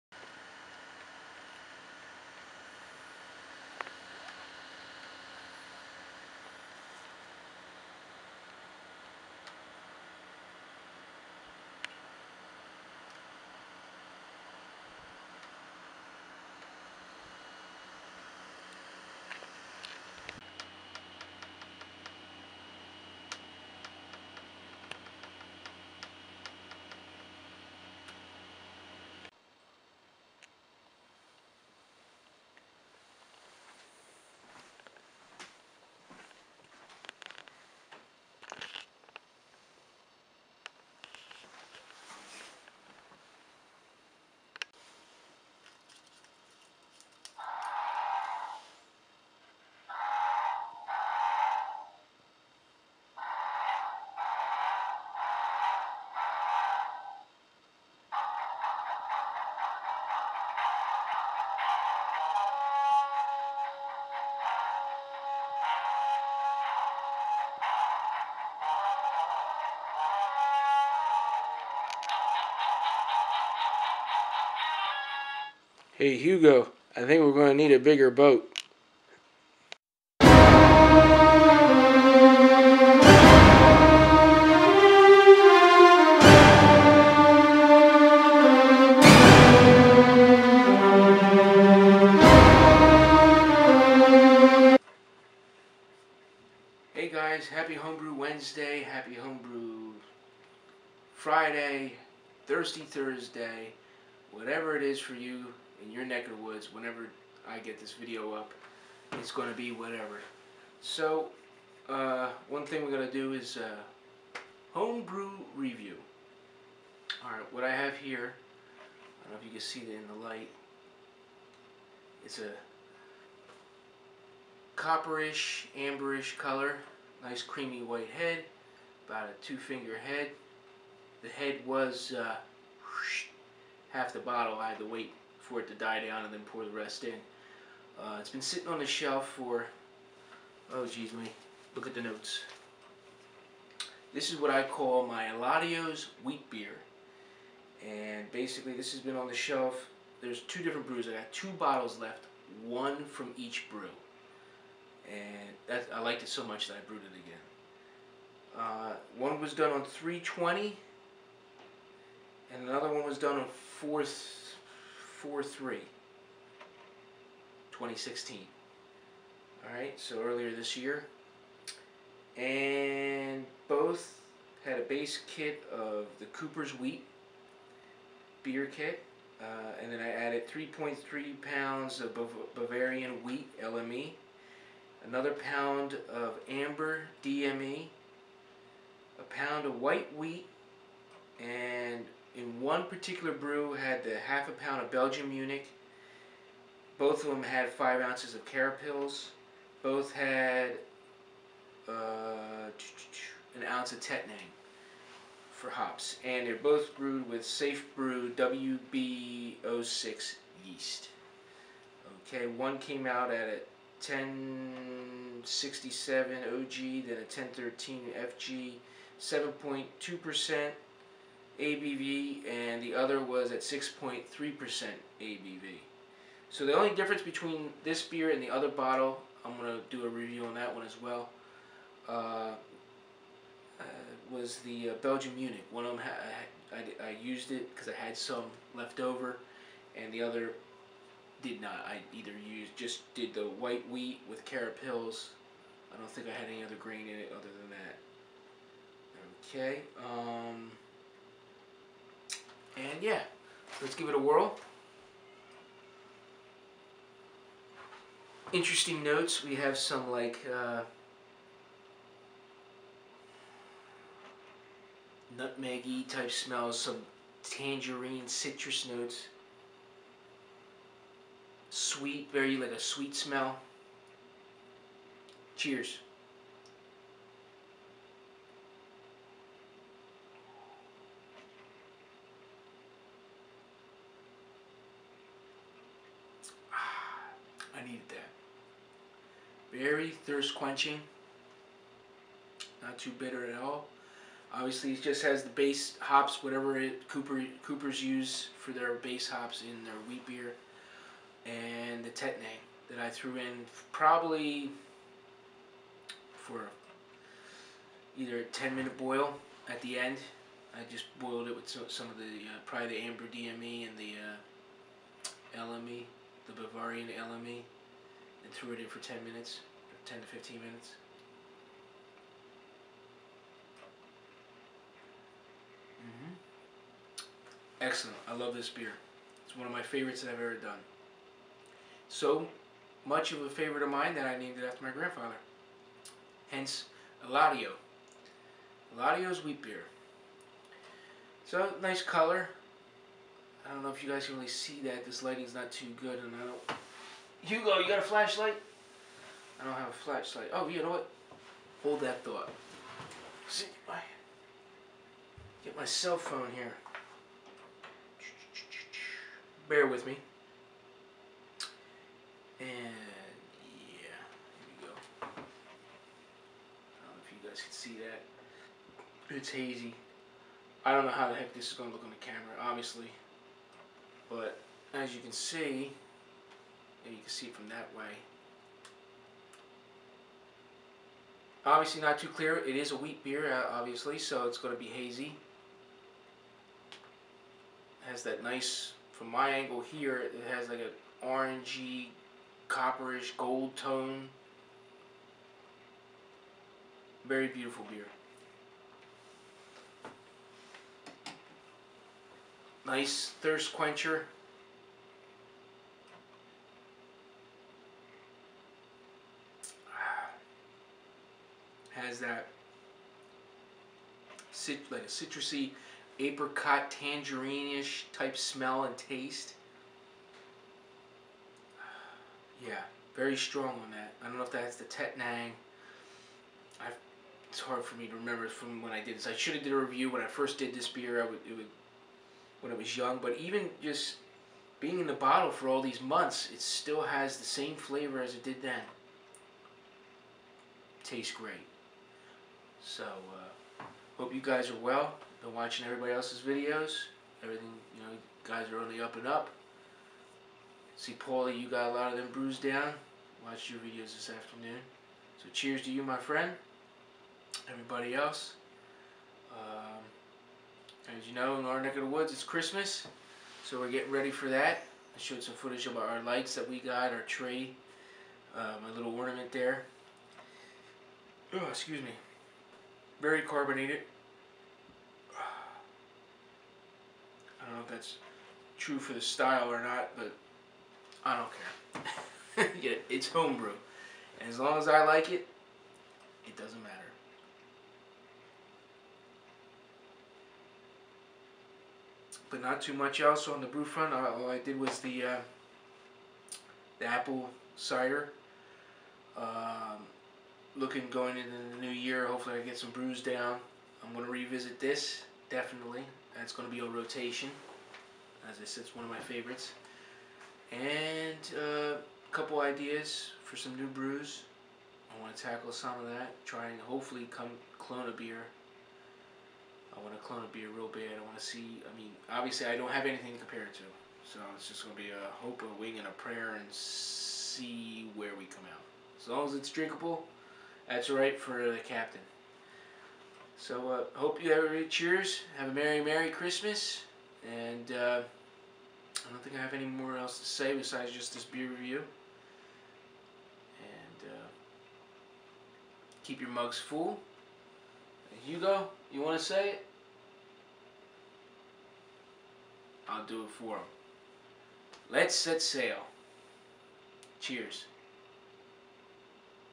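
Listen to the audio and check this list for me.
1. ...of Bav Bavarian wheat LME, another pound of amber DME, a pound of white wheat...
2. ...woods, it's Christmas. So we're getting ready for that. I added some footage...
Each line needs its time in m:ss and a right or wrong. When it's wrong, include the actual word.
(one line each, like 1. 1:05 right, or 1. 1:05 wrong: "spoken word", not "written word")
1. 3:01 right
2. 7:42 wrong: "showed", not "added".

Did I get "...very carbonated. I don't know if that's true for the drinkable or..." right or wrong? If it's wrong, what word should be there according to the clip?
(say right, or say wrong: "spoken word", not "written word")
wrong: "style", not "drinkable".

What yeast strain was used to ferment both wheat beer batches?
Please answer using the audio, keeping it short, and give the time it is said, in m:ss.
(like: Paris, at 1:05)
Safe Brew WB06, at 3:27.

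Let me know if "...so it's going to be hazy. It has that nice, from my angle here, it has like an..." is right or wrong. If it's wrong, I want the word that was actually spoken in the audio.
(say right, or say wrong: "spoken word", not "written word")
right.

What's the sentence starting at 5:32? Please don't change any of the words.
So much of a favorite of mine that I named it after my grandfather.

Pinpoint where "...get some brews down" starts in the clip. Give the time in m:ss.
8:22.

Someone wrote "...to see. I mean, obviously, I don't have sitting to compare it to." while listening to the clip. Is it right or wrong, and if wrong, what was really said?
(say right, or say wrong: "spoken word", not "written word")
wrong: "anything", not "sitting".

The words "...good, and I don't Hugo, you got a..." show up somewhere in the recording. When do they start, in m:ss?
5:46.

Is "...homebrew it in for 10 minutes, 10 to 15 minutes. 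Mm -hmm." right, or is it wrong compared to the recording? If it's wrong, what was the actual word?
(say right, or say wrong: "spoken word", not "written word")
wrong: "threw", not "homebrew".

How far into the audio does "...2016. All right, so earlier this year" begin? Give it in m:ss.
2:47.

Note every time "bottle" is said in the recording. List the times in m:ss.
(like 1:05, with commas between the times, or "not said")
2:14, 2:31, 3:48, 7:15.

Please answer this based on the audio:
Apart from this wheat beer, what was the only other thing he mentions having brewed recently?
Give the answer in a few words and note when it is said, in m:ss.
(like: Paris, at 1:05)
apple cider, at 8:17.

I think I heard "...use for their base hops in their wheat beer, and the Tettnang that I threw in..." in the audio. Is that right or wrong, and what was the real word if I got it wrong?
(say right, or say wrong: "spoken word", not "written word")
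right.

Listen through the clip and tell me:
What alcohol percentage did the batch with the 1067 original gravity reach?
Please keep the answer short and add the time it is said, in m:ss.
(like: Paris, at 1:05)
7.2%, at 3:39.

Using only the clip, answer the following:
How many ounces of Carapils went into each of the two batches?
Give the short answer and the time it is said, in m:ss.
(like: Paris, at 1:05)
5, at 3:17.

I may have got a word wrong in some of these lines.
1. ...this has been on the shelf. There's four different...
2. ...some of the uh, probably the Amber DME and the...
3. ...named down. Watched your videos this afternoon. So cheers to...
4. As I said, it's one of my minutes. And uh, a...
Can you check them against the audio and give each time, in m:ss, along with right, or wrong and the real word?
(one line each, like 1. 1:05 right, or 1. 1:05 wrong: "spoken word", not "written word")
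1. 2:28 wrong: "two", not "four"
2. 5:11 right
3. 7:32 wrong: "bruised", not "named"
4. 8:28 wrong: "favorites", not "minutes".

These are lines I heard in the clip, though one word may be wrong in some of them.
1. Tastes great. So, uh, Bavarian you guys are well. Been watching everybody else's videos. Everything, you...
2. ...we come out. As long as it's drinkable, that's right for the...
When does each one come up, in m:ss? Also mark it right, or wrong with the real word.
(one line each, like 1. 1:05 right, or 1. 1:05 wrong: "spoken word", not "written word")
1. 7:21 wrong: "Hope", not "Bavarian"
2. 8:48 right.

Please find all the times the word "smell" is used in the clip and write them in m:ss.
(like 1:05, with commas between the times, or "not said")
4:26, 4:33, 6:58.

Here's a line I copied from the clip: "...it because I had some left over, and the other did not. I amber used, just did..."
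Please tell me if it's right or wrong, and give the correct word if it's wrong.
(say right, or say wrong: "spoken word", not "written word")
wrong: "either", not "amber".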